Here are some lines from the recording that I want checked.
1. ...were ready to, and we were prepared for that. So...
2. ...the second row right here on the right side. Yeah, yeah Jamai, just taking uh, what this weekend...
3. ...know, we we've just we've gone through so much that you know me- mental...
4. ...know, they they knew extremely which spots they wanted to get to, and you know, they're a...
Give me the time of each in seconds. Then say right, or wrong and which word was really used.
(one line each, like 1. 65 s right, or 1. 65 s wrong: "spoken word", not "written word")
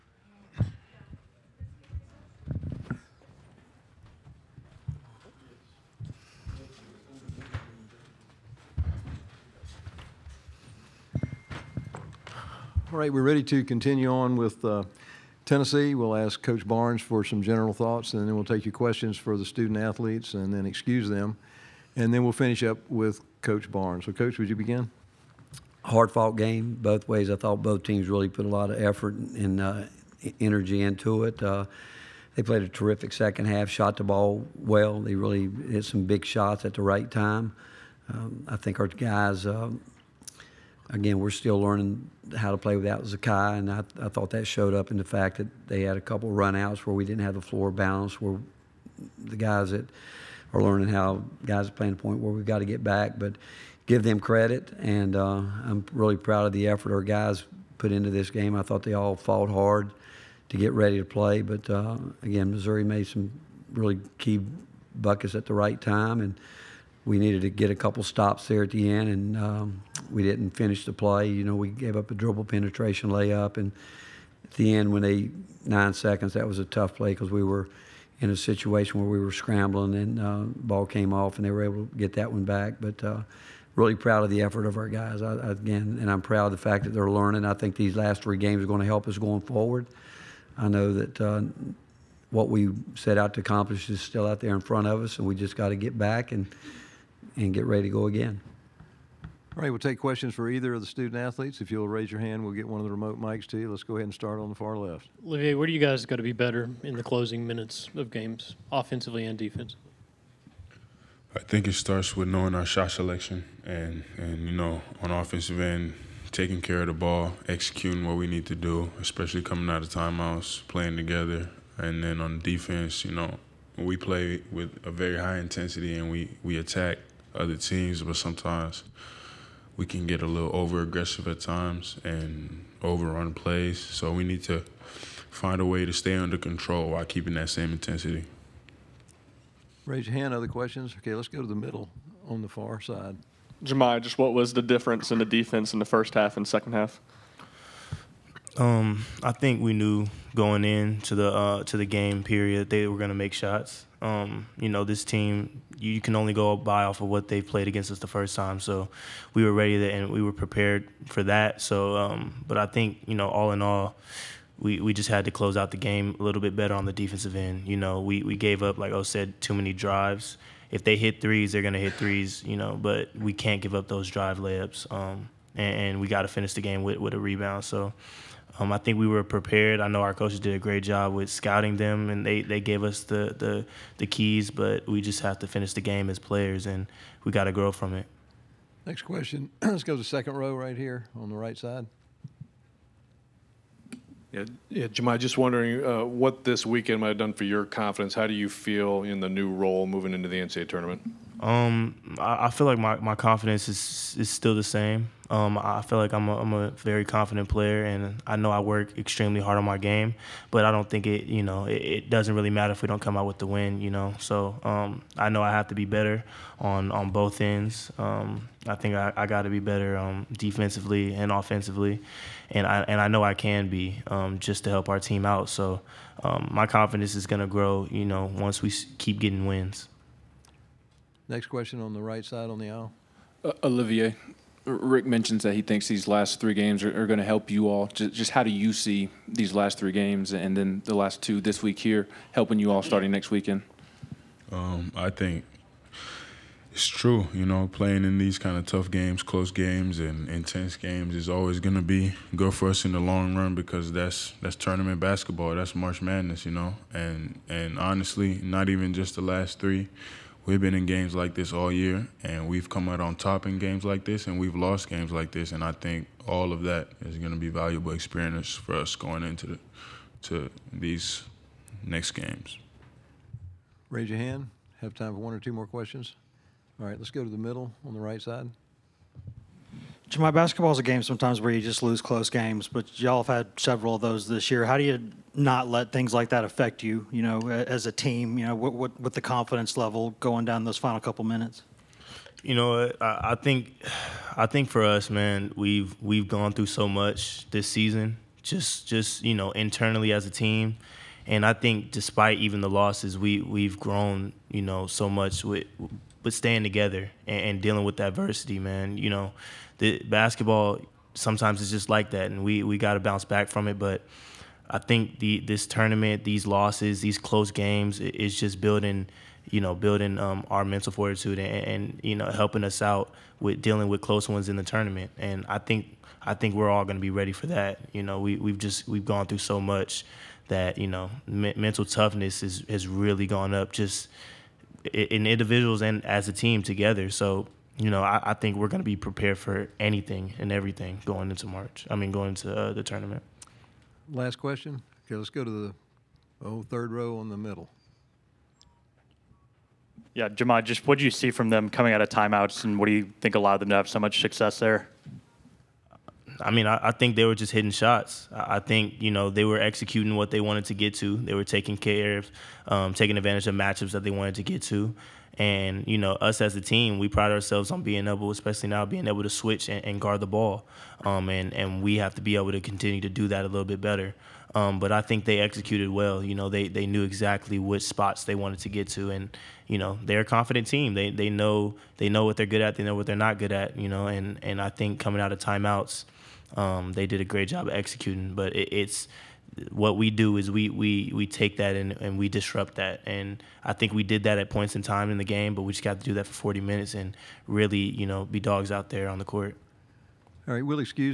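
1. 159 s right
2. 189 s wrong: "wondering", not "taking"
3. 328 s right
4. 376 s wrong: "exactly", not "extremely".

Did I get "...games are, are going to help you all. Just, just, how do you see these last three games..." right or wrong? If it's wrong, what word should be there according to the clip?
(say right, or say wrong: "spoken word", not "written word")
right.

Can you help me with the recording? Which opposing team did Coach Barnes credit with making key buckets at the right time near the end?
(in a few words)
Missouri.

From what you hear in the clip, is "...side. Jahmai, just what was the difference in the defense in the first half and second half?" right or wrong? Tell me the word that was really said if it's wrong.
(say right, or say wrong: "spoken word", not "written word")
right.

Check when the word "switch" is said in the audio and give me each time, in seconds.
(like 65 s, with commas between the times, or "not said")
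369 s.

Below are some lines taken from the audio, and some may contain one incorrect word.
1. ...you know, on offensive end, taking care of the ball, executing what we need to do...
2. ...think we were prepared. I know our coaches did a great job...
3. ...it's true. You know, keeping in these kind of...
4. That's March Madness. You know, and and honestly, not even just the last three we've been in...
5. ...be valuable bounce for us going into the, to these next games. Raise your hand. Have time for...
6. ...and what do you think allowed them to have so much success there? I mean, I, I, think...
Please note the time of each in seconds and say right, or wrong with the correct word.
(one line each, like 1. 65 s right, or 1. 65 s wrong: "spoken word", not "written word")
1. 114 s right
2. 178 s right
3. 246 s wrong: "playing", not "keeping"
4. 255 s right
5. 267 s wrong: "experience", not "bounce"
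6. 352 s right.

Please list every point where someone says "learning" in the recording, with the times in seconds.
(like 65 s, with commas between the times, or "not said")
41 s, 50 s, 87 s.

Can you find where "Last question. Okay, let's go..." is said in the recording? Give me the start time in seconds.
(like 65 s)
344 s.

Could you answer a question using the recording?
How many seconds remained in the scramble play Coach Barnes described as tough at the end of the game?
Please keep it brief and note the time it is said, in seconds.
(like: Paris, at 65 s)
9, at 75 s.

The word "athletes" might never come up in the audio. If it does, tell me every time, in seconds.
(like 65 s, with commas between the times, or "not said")
19 s, 101 s.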